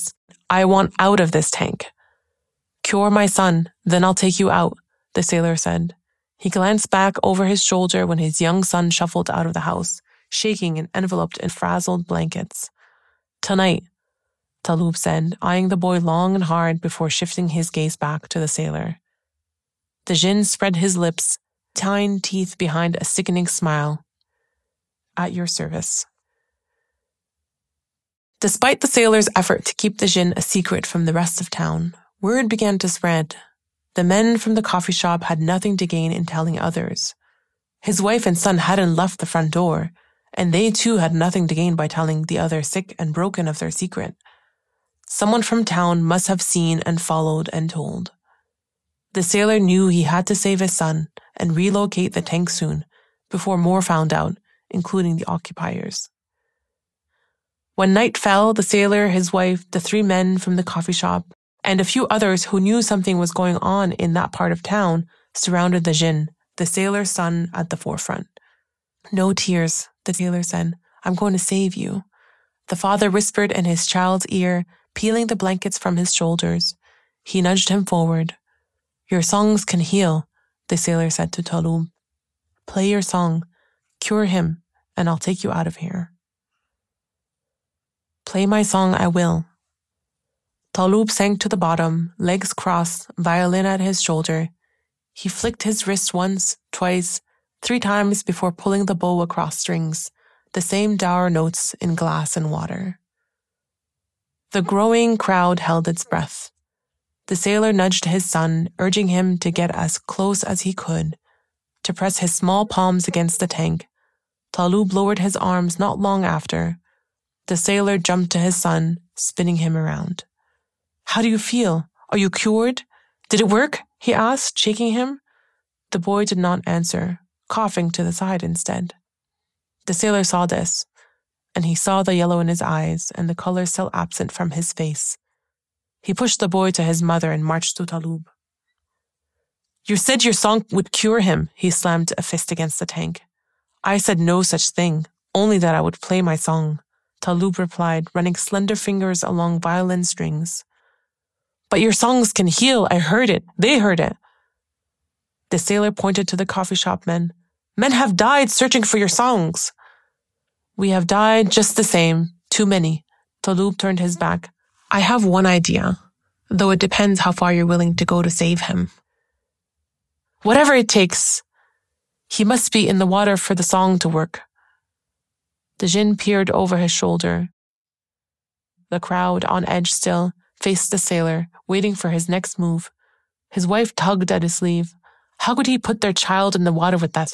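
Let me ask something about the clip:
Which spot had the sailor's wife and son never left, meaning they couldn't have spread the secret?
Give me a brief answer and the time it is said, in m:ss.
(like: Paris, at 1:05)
The front door, at 0:39.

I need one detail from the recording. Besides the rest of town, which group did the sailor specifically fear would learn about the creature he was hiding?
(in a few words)
The occupiers.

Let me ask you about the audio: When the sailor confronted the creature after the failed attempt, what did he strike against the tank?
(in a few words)
A fist.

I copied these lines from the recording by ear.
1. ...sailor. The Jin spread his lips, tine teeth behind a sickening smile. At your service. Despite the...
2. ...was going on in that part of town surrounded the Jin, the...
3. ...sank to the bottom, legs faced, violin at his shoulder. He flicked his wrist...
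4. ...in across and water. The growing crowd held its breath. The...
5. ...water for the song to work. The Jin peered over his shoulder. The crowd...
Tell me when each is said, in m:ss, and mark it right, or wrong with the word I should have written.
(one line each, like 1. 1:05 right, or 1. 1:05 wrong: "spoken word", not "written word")
1. 0:18 right
2. 1:03 right
3. 1:31 wrong: "crossed", not "faced"
4. 1:41 wrong: "glass", not "across"
5. 2:53 right.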